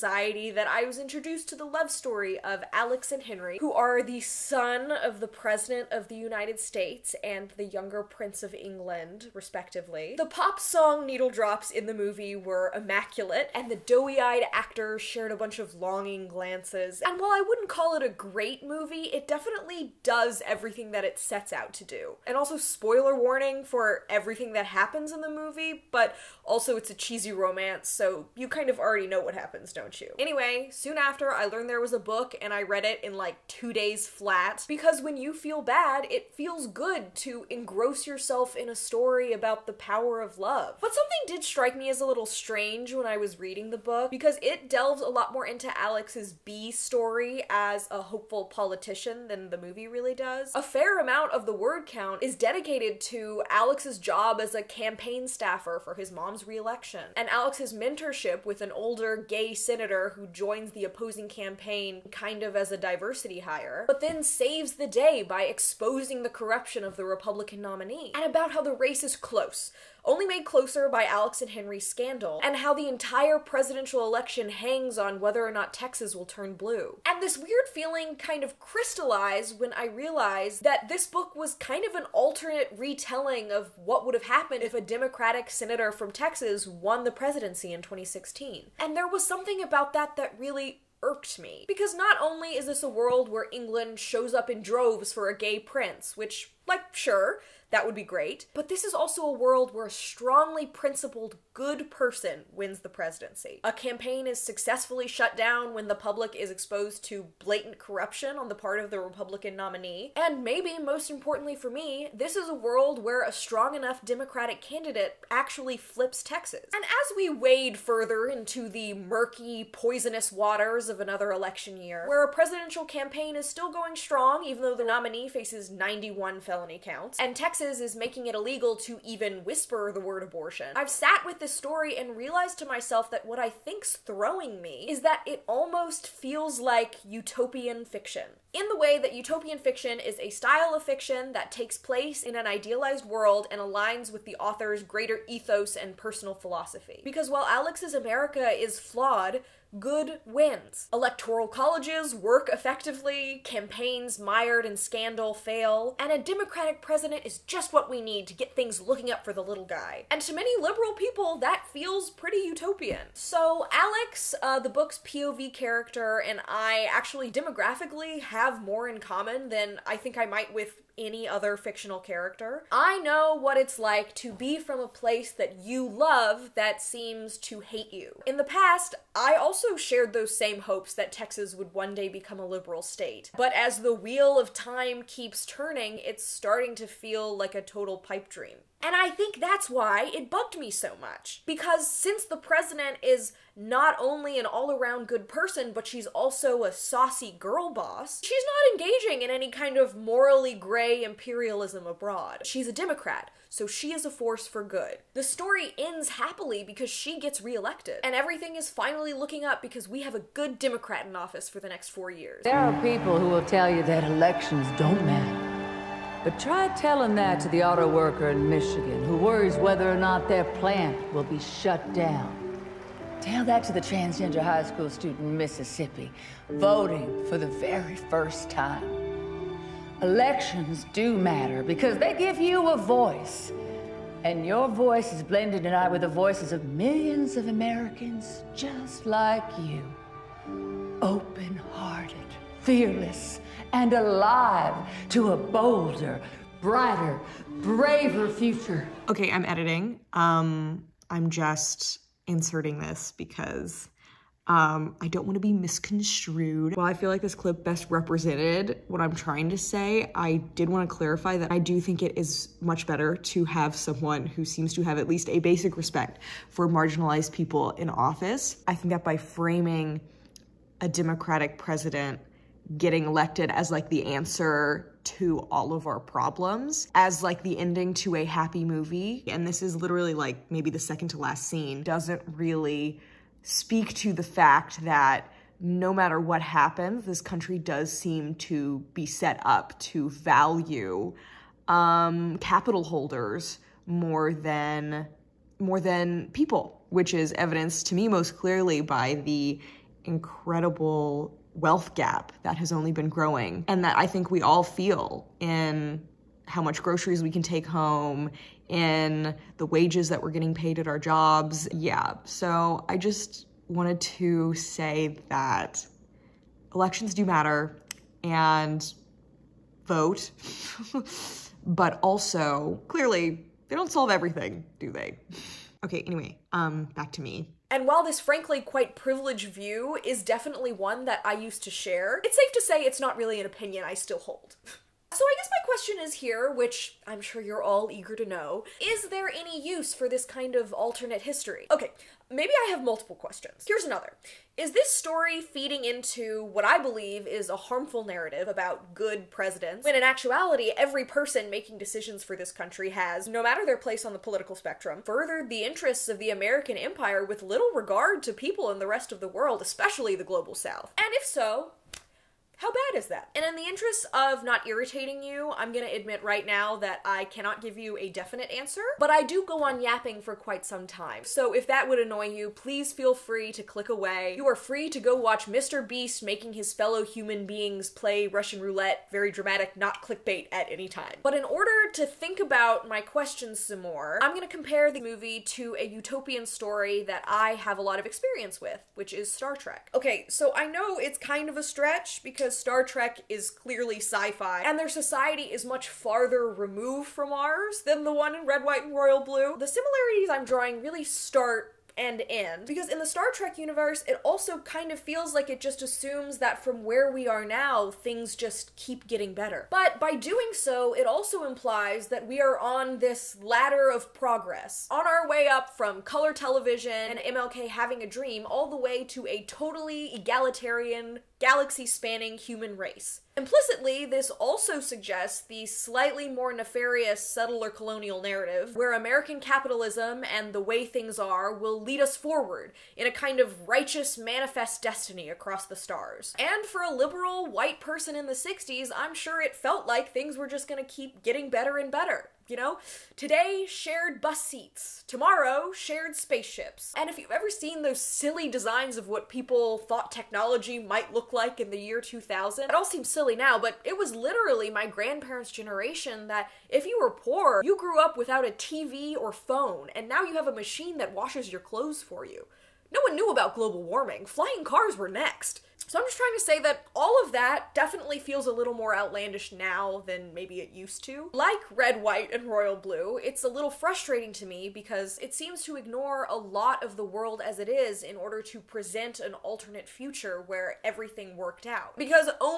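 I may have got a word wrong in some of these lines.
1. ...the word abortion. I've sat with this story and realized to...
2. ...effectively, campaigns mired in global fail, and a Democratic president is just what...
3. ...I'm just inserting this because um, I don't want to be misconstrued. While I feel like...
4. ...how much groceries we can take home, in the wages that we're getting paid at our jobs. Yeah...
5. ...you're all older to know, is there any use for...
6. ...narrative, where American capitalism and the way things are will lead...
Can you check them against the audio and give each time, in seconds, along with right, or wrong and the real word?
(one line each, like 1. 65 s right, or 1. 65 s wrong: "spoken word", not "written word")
1. 129 s right
2. 152 s wrong: "scandal", not "global"
3. 251 s right
4. 306 s right
5. 337 s wrong: "eager", not "older"
6. 428 s right.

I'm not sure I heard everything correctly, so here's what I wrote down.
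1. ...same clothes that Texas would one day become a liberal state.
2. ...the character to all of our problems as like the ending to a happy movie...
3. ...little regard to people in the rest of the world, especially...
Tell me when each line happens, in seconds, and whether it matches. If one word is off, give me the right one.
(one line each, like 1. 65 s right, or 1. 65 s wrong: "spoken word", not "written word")
1. 180 s wrong: "hopes", not "clothes"
2. 273 s wrong: "answer", not "character"
3. 357 s right.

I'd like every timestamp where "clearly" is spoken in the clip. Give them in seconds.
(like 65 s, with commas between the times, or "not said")
298 s, 322 s, 393 s.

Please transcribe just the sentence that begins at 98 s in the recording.
But this is also a world where a strongly principled good person wins the presidency.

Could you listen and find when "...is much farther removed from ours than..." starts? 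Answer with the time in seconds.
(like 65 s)
395 s.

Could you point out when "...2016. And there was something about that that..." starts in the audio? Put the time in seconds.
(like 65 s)
87 s.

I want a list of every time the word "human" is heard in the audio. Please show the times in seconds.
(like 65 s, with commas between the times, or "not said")
377 s, 422 s.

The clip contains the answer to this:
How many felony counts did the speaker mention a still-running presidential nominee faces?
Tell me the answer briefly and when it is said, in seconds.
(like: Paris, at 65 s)
91, at 125 s.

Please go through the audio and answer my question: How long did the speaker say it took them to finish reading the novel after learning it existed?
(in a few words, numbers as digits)
2 days.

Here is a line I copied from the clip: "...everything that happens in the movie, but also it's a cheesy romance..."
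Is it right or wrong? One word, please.
right.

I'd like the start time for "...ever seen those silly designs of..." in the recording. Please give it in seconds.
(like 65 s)
447 s.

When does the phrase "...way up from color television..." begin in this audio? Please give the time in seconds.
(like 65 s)
415 s.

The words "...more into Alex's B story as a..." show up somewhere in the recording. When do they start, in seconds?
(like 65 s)
45 s.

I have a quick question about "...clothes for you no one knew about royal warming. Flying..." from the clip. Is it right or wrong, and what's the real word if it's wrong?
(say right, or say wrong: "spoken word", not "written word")
wrong: "global", not "royal".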